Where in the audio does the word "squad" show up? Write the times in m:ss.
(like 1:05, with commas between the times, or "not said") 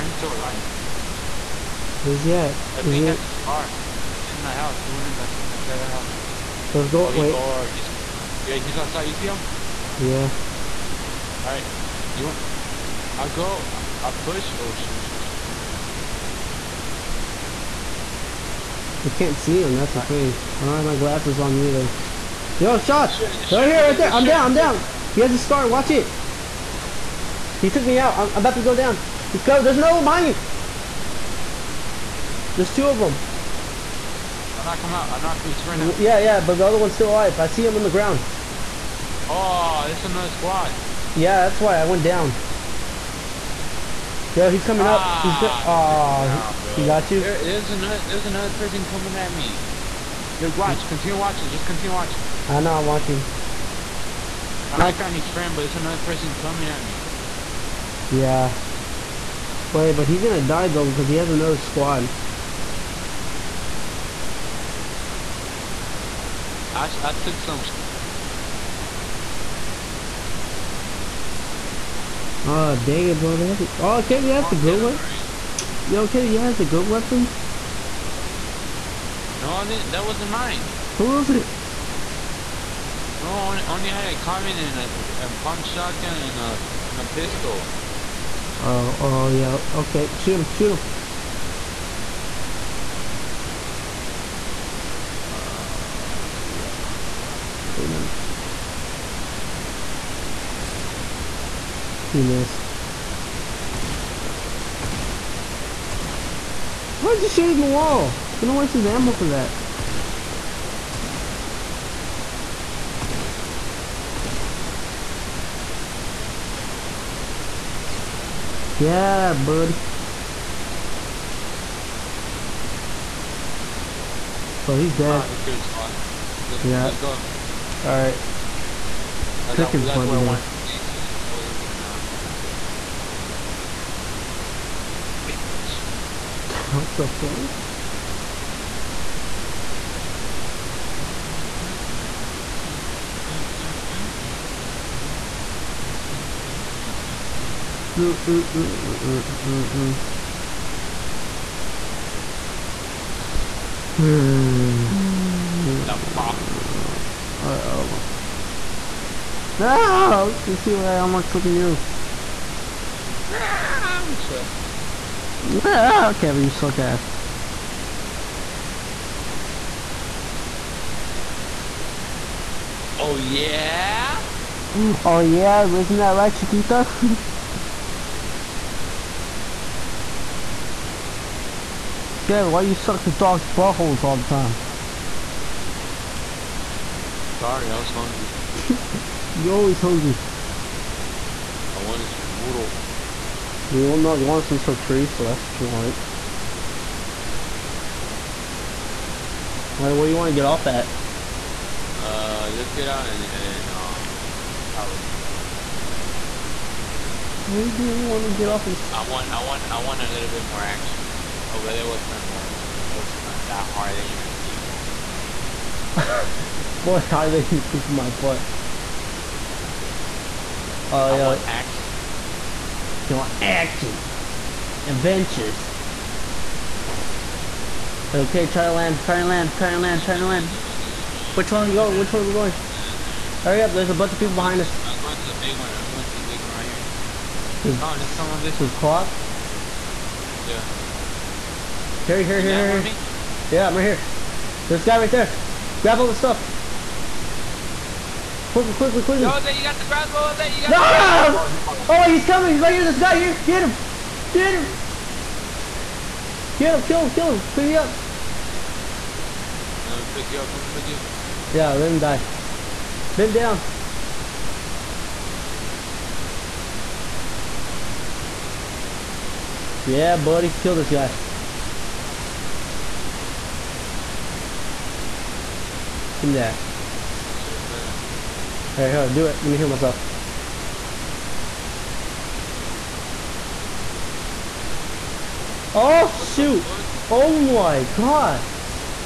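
0:40, 1:01.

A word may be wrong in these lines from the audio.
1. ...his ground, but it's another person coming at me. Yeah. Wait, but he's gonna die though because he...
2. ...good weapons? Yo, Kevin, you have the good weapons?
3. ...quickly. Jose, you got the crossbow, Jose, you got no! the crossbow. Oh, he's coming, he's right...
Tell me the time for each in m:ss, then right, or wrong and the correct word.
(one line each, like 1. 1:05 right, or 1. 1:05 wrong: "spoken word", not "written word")
1. 0:55 wrong: "friend", not "ground"
2. 1:14 right
3. 4:09 right.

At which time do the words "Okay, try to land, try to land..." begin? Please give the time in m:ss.
3:48.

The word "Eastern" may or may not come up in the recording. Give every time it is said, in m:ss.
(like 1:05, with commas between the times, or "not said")
not said.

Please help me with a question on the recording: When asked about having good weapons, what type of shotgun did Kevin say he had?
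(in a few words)
pump shotgun.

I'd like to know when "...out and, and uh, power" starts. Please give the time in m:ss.
3:22.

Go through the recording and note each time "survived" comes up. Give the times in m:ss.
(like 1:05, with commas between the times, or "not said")
2:12.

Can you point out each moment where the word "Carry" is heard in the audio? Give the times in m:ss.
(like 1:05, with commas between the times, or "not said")
4:02.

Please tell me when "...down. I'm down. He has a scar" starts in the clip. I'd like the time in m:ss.
0:24.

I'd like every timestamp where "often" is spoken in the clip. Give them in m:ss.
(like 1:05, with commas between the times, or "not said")
not said.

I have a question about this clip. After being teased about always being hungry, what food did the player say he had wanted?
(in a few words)
noodles.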